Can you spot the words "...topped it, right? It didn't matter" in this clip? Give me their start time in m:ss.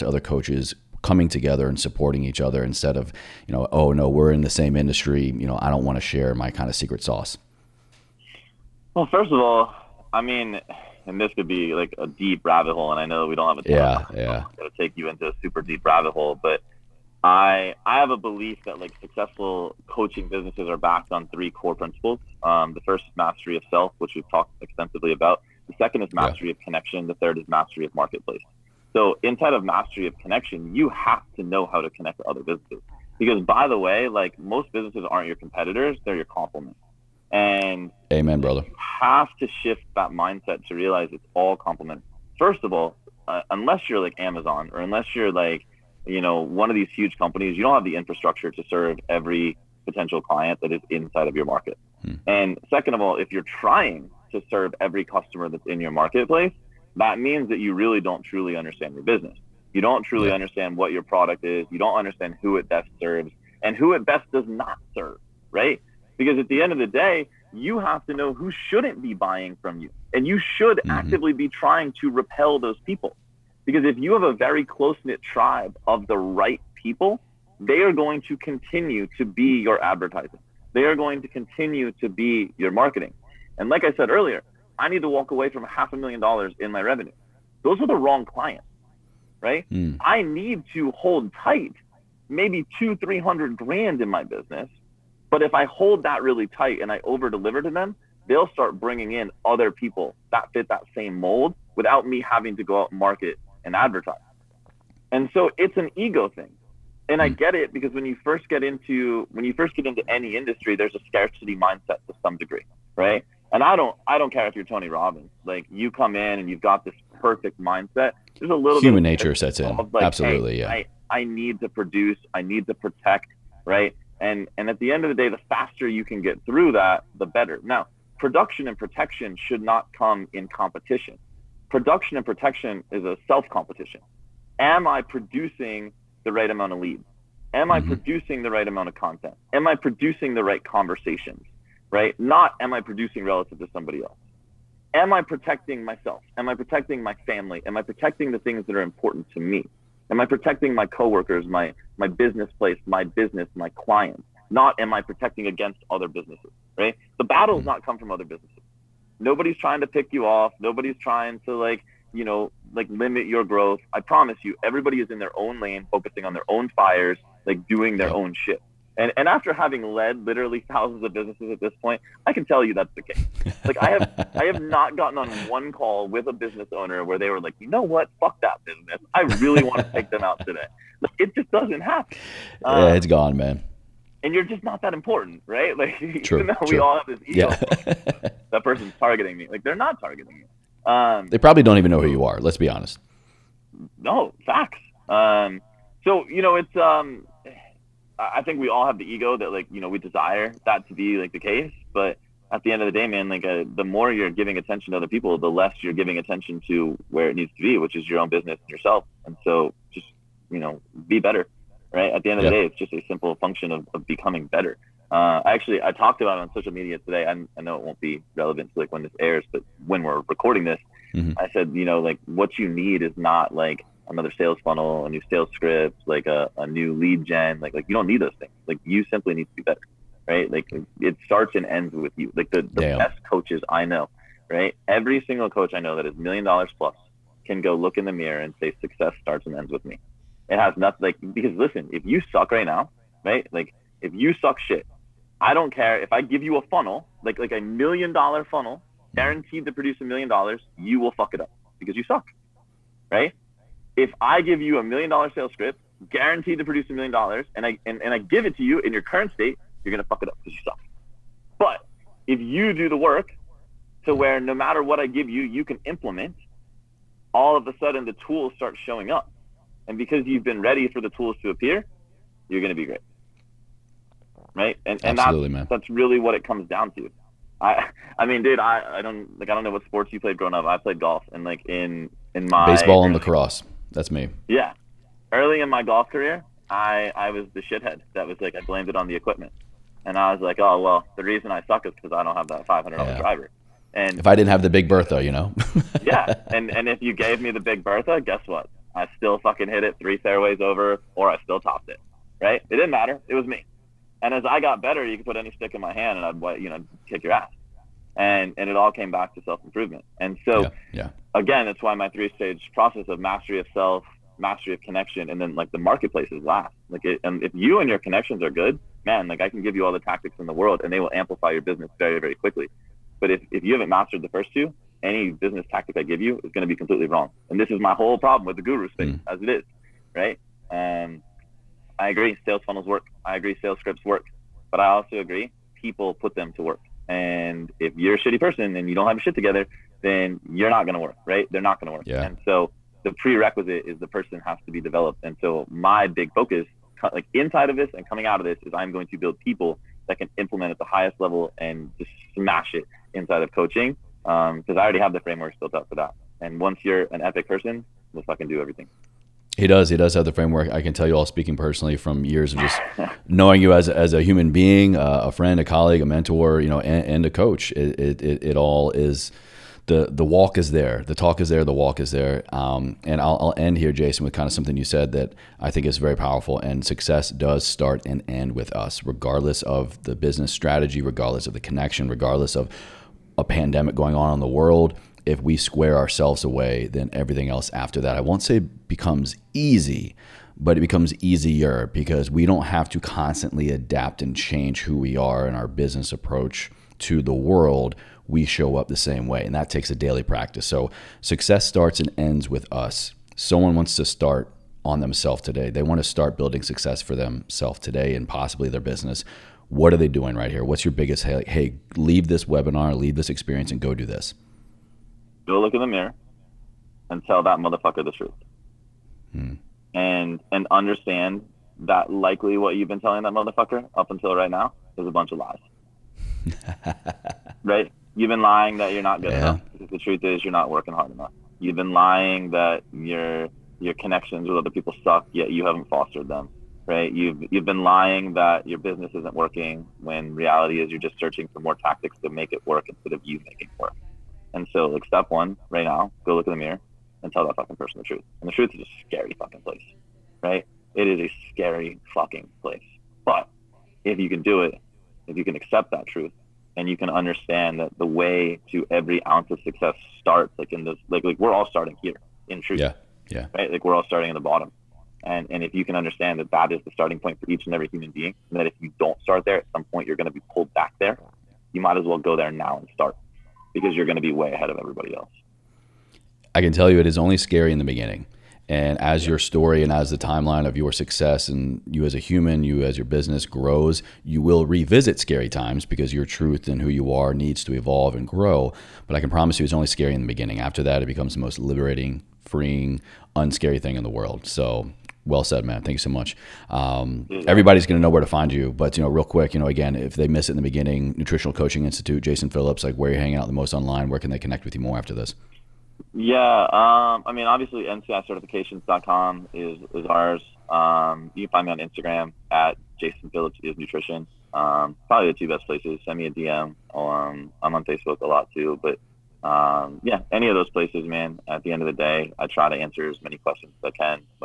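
5:01.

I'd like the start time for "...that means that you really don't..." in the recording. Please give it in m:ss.
0:56.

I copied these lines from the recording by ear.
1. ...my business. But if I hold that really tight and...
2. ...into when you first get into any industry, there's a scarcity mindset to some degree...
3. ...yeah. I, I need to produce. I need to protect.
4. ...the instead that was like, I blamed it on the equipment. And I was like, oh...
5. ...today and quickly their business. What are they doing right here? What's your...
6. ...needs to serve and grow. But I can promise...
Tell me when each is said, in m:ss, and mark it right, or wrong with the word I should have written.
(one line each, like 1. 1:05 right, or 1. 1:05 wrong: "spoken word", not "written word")
1. 1:34 right
2. 1:48 right
3. 2:00 right
4. 4:47 wrong: "shithead", not "instead"
5. 6:47 wrong: "possibly", not "quickly"
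6. 8:07 wrong: "evolve", not "serve".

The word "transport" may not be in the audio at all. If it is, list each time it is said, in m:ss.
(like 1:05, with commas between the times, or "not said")
not said.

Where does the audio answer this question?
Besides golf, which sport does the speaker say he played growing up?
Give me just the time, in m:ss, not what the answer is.
4:43.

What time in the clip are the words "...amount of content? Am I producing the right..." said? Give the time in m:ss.
2:18.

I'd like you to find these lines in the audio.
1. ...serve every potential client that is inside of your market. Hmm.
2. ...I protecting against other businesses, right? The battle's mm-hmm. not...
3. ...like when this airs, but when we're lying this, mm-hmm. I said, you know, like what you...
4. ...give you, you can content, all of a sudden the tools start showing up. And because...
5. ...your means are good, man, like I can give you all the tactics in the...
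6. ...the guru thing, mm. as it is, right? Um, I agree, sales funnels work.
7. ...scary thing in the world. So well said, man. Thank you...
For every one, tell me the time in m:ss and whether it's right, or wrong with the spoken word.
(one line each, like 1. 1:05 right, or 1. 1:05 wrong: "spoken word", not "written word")
1. 0:48 right
2. 2:34 right
3. 3:38 wrong: "recording", not "lying"
4. 4:25 wrong: "implement", not "content"
5. 5:17 wrong: "connections", not "means"
6. 5:28 right
7. 8:13 wrong: "unscary", not "scary".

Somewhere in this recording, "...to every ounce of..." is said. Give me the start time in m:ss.
7:38.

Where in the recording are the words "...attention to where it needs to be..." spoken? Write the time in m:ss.
3:26.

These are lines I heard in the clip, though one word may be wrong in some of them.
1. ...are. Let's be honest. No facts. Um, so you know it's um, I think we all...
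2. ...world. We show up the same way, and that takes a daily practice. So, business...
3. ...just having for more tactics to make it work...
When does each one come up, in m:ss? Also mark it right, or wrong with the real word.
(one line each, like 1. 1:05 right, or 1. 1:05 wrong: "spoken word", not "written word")
1. 3:12 right
2. 6:37 wrong: "success", not "business"
3. 7:20 wrong: "searching", not "having".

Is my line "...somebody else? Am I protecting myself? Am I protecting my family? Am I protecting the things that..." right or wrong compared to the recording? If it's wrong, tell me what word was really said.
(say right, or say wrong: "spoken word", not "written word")
right.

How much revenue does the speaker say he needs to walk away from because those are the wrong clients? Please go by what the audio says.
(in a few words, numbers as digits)
Half a million dollars.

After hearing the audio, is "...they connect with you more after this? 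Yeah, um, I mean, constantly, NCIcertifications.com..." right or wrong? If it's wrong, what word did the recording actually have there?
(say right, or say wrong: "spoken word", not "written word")
wrong: "obviously", not "constantly".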